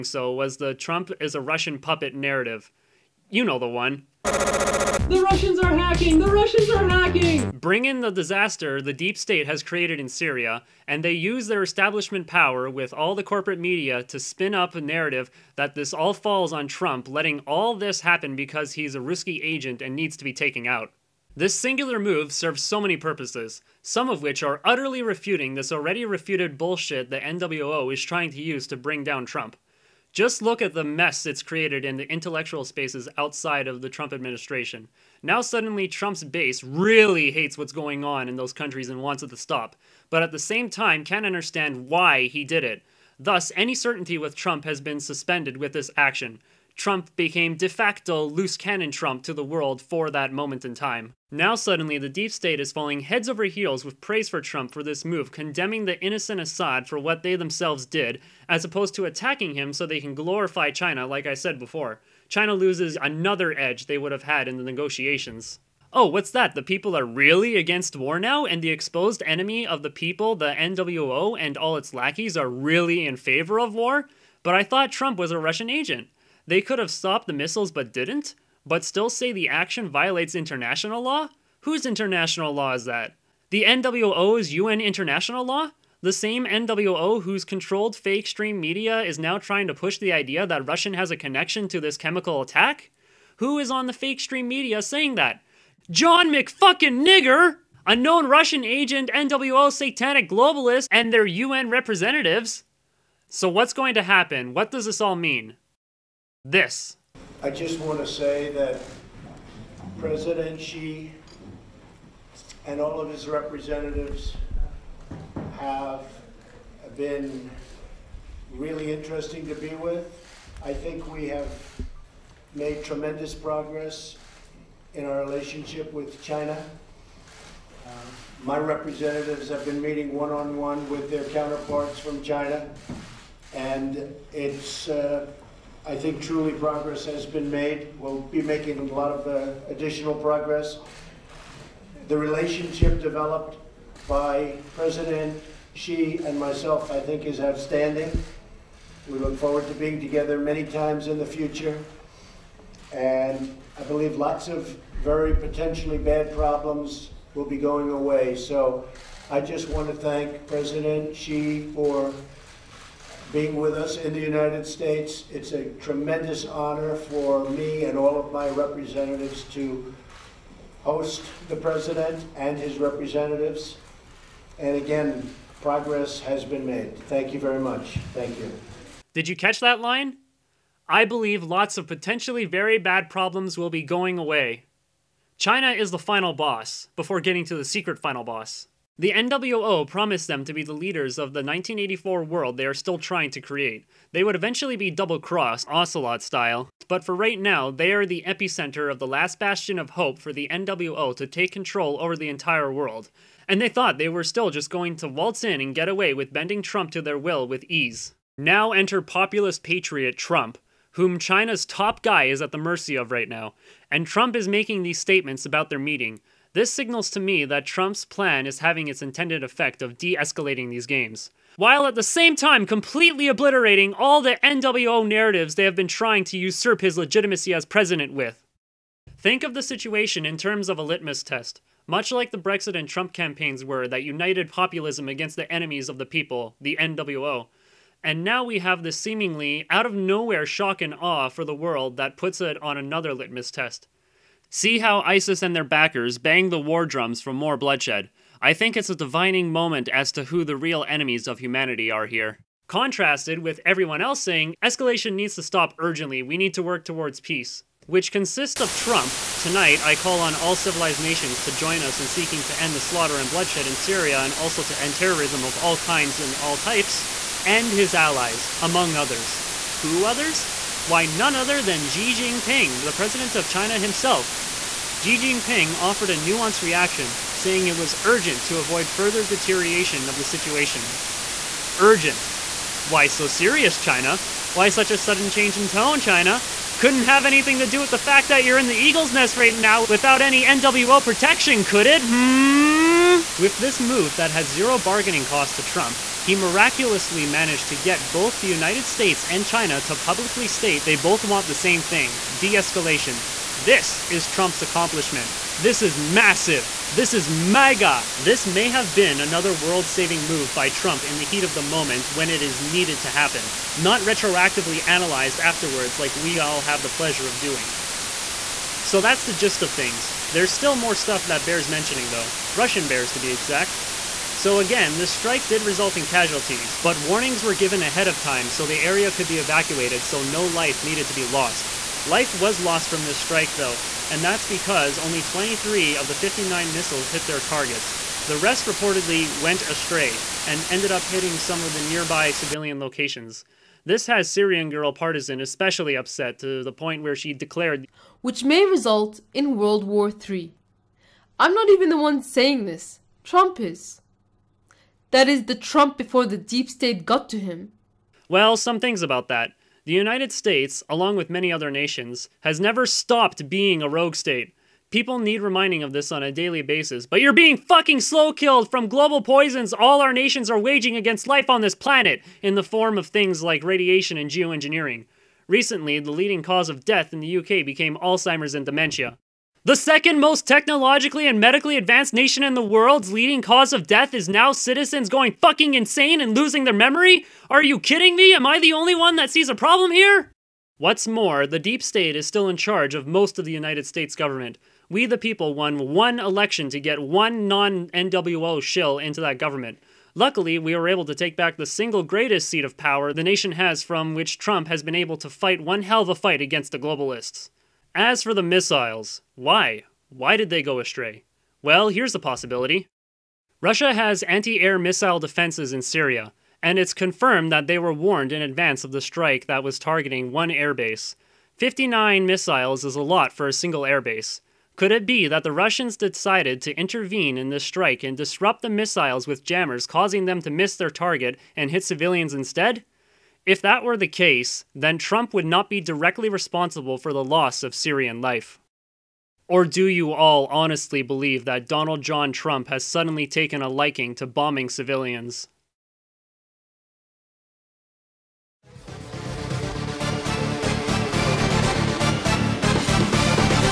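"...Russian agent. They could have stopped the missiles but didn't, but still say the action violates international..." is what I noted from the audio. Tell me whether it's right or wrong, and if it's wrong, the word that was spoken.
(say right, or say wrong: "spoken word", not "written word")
right.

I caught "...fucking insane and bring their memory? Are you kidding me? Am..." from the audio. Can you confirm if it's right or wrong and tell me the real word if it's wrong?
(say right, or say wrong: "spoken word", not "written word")
wrong: "losing", not "bring".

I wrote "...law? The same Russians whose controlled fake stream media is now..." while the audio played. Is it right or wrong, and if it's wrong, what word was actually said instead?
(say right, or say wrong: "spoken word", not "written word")
wrong: "NWO", not "Russians".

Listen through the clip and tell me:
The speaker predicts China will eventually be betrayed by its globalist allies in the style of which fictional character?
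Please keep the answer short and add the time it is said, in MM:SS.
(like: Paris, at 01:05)
Ocelot, at 03:15.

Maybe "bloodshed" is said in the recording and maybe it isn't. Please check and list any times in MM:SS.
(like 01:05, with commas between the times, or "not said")
04:07, 04:23.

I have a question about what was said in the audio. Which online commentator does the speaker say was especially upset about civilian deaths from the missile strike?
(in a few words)
Syrian Girl Partisan.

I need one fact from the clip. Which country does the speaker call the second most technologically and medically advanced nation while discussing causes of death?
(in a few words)
UK.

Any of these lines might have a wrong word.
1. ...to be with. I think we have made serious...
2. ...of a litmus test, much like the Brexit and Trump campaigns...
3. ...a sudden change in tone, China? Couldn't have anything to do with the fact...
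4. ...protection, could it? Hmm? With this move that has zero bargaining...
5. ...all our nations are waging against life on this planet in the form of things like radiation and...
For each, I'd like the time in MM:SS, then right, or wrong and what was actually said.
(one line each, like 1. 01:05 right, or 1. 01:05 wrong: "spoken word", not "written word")
1. 01:59 wrong: "tremendous", not "serious"
2. 03:50 right
3. 04:44 right
4. 04:51 right
5. 06:09 right.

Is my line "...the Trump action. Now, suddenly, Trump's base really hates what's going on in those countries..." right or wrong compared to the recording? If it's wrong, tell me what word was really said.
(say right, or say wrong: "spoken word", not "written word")
wrong: "administration", not "action".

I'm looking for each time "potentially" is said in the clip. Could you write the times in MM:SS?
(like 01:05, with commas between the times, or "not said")
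02:35, 03:01.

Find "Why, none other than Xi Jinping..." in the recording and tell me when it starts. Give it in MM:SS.
04:30.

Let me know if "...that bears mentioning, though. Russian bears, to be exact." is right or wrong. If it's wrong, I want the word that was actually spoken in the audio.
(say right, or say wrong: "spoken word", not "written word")
right.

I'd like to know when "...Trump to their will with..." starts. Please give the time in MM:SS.
03:26.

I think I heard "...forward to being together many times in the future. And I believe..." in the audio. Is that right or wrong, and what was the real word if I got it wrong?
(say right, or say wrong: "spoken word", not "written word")
right.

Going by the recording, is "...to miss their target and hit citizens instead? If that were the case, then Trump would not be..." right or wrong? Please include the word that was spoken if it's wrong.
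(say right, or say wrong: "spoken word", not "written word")
wrong: "civilians", not "citizens".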